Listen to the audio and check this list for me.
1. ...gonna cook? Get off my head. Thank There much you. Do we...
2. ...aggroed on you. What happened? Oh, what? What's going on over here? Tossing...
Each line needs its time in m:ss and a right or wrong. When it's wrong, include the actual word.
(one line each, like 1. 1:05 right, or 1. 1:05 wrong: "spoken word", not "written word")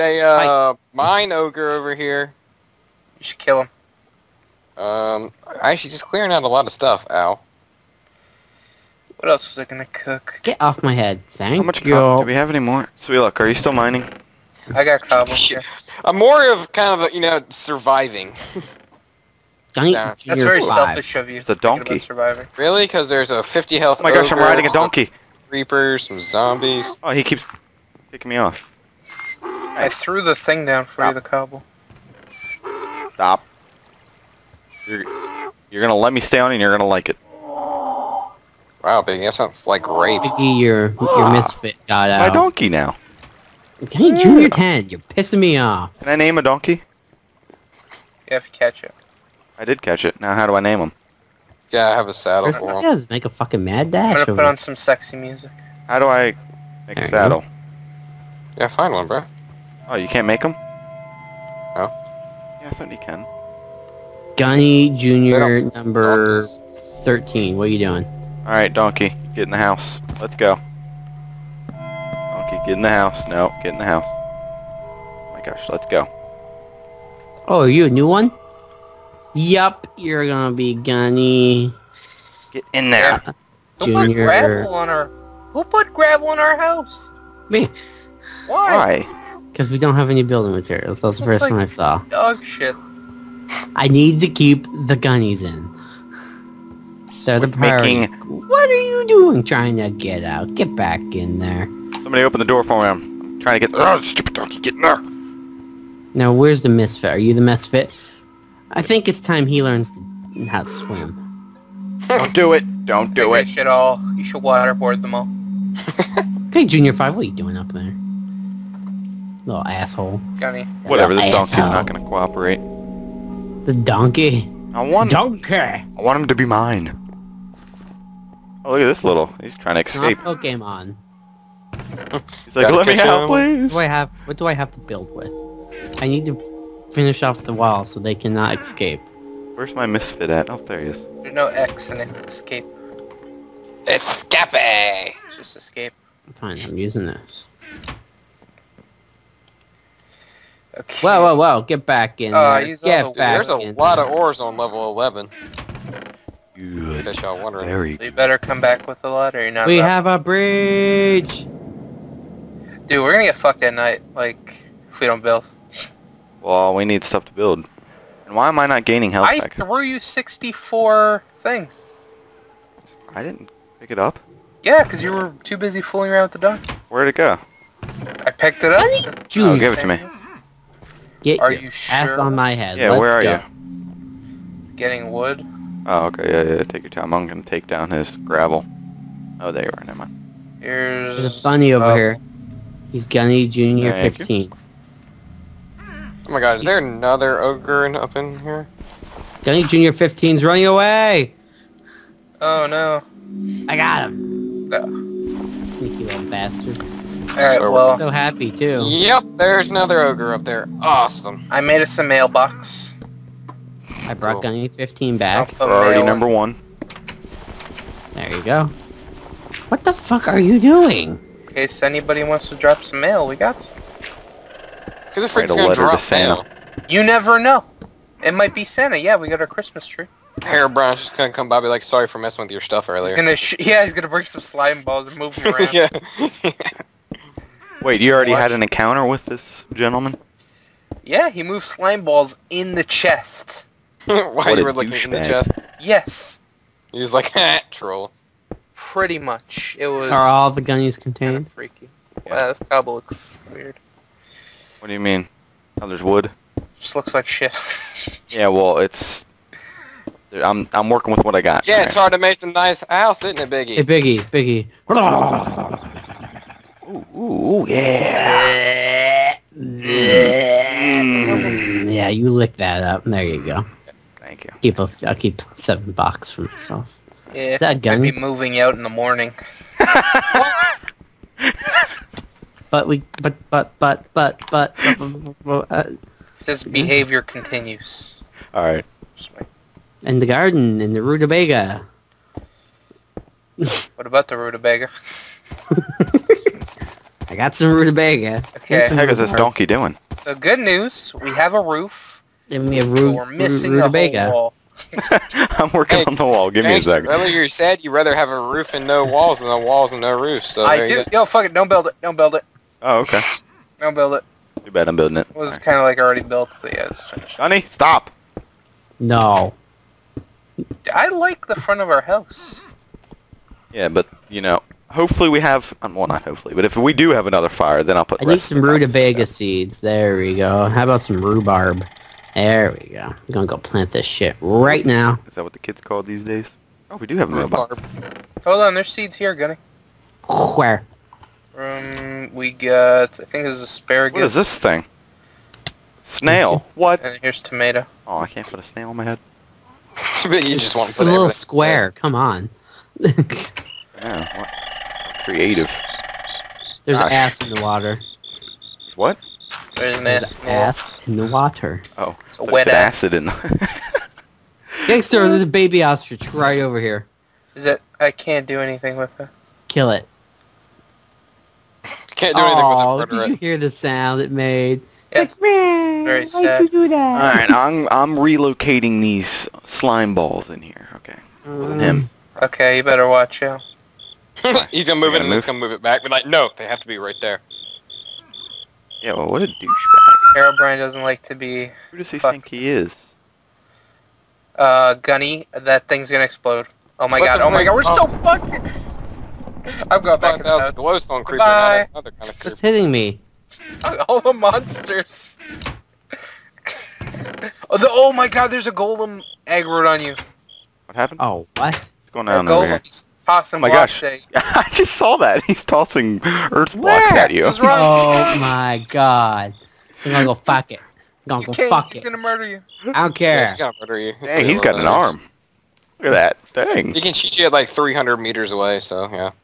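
1. 0:09 wrong: "How", not "There"
2. 6:49 right.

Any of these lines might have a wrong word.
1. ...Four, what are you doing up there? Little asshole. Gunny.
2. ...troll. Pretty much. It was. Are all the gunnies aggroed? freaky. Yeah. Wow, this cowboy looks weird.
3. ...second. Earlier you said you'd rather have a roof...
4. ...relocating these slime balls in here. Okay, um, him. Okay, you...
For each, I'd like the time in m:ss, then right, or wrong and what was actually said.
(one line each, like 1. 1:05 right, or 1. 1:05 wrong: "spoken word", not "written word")
1. 1:56 wrong: "Five", not "Four"
2. 4:07 wrong: "contained", not "aggroed"
3. 5:06 right
4. 6:18 right.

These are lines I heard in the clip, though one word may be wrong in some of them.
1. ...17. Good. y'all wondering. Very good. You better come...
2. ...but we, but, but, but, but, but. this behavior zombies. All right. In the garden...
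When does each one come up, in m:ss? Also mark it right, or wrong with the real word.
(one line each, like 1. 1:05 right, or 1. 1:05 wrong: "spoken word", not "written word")
1. 2:34 wrong: "11", not "17"
2. 4:42 wrong: "continues", not "zombies".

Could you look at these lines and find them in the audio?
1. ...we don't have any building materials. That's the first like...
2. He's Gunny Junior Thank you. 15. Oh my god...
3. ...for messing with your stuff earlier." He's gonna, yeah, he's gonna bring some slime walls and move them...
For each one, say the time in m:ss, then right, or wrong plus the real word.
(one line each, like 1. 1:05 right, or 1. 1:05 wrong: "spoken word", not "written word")
1. 1:29 right
2. 3:12 right
3. 3:52 wrong: "balls", not "walls".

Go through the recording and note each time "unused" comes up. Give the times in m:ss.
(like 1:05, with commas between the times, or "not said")
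not said.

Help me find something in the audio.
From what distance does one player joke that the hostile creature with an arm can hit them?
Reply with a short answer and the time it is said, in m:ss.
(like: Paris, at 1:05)
300 meters, at 7:07.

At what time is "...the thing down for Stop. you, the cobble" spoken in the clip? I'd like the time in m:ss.
0:30.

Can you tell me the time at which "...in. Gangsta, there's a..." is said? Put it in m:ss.
6:03.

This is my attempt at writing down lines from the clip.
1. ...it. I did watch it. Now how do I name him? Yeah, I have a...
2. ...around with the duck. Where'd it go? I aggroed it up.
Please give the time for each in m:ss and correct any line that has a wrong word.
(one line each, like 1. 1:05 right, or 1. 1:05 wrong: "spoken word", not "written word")
1. 0:48 wrong: "catch", not "watch"
2. 2:56 wrong: "picked", not "aggroed".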